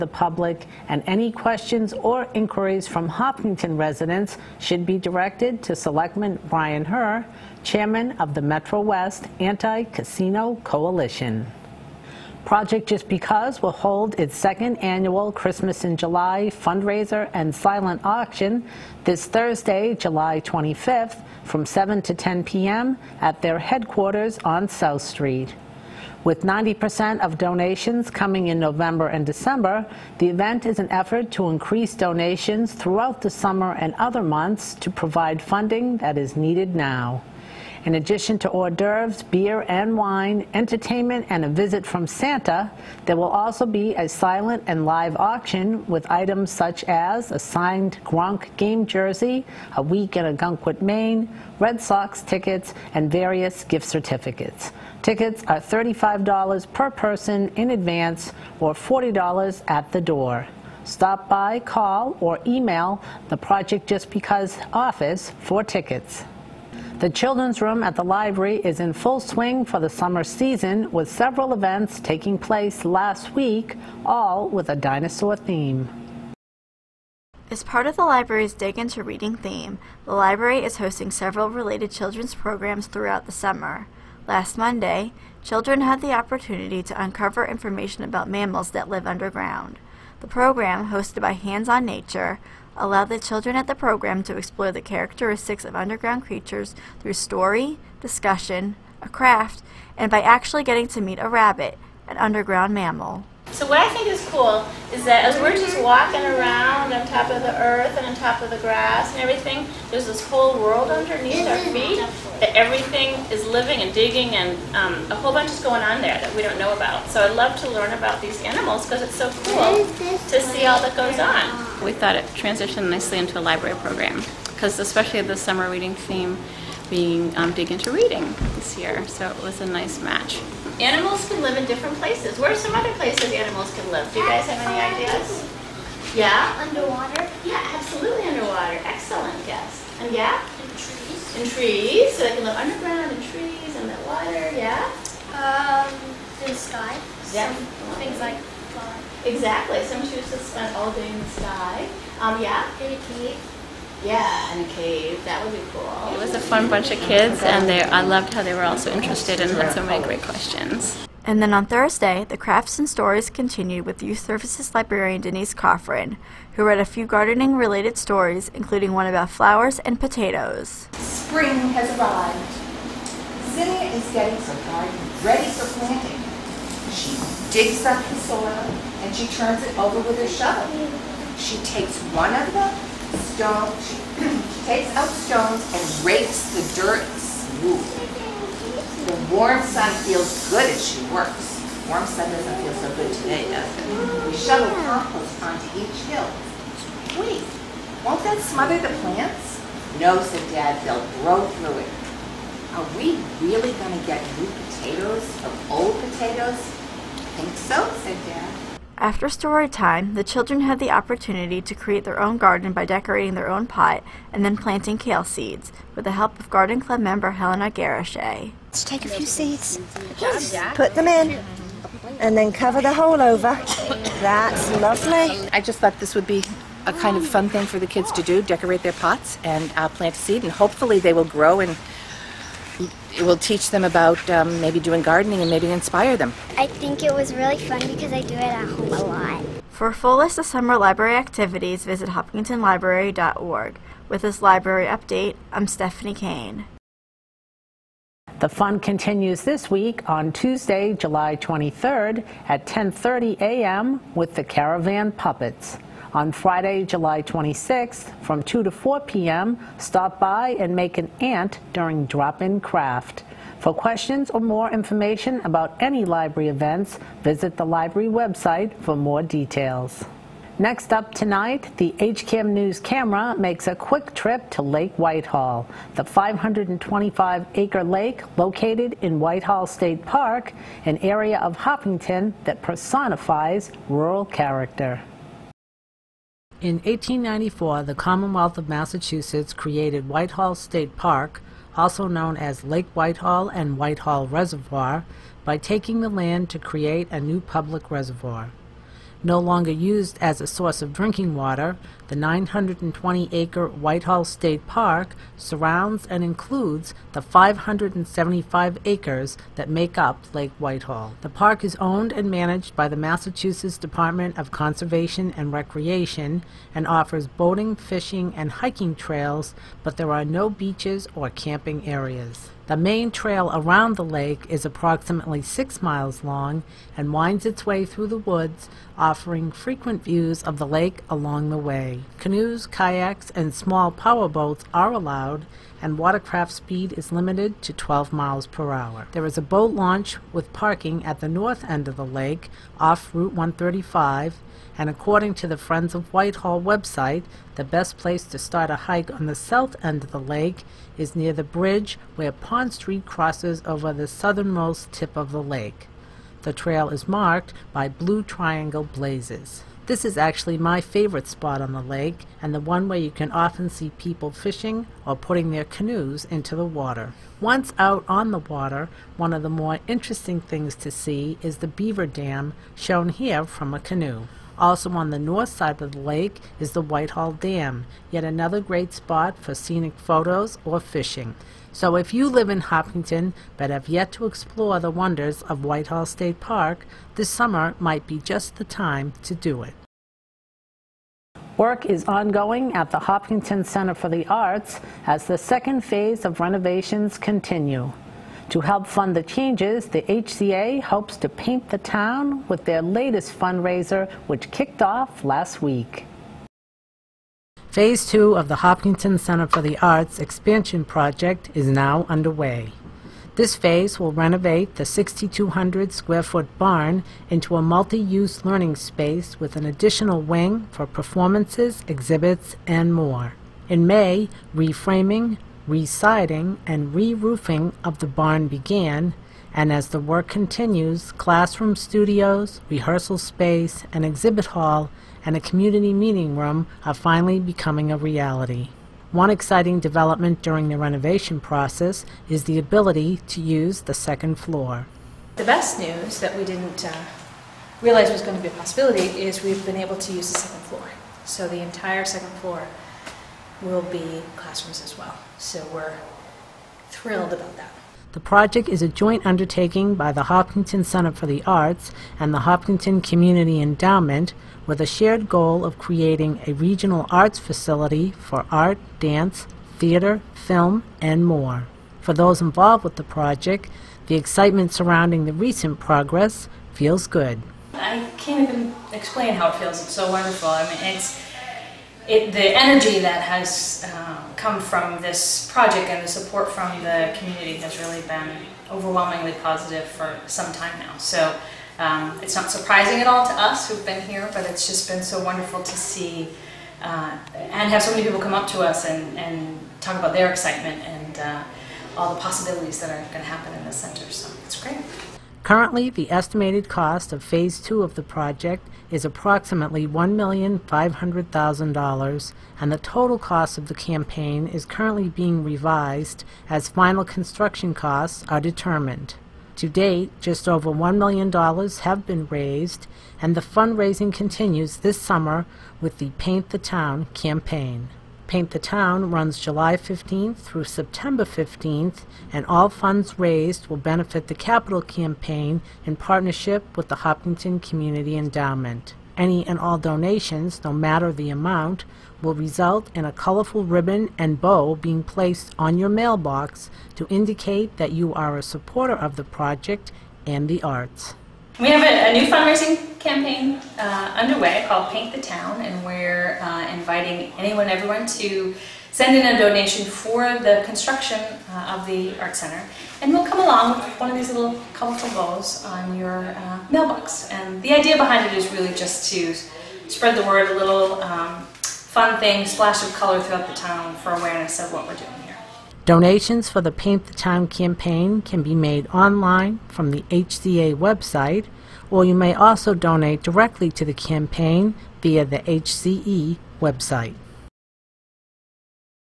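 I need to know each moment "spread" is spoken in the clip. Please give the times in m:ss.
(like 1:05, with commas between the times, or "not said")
9:29.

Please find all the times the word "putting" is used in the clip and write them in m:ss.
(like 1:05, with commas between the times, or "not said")
6:05.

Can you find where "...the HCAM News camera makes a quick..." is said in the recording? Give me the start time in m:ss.
4:31.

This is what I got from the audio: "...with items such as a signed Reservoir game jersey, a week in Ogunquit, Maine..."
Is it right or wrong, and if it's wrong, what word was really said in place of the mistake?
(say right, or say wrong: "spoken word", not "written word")
wrong: "Gronk", not "Reservoir".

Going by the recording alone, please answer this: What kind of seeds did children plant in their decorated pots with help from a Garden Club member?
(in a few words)
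Kale.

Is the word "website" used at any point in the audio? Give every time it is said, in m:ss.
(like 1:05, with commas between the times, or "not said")
4:28, 5:46, 9:40, 9:46.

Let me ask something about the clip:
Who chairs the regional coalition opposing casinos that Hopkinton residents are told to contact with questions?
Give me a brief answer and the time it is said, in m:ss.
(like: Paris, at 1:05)
Brian Herr, at 0:06.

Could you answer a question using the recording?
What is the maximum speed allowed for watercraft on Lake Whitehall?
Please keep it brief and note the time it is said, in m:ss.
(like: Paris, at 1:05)
12 miles per hour, at 5:37.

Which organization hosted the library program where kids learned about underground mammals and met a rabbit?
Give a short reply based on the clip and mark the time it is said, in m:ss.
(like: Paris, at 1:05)
Hands on Nature, at 1:31.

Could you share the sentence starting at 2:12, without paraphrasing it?
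Where are some other places animals can live?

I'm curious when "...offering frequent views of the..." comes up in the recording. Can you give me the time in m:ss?
5:28.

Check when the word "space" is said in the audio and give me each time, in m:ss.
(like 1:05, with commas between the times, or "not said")
6:58, 7:13.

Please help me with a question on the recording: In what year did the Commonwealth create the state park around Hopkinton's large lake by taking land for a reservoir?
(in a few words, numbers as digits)
1894.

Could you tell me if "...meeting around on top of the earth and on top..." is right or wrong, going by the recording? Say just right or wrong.
wrong.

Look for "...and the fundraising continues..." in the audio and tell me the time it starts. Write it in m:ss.
8:43.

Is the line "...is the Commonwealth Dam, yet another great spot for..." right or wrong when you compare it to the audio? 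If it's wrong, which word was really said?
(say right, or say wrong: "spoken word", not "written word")
wrong: "Whitehall", not "Commonwealth".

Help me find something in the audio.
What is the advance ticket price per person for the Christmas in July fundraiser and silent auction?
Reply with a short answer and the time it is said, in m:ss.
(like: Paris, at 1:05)
$35, at 0:55.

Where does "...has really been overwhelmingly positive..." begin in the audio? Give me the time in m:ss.
8:07.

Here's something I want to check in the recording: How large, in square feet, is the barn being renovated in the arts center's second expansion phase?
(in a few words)
6,200 square feet.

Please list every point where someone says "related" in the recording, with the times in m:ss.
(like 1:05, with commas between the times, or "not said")
1:21, 2:47.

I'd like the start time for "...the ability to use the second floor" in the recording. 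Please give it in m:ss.
7:22.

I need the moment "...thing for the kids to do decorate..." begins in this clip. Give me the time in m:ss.
3:47.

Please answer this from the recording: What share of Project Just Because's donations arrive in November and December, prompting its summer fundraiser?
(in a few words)
90%.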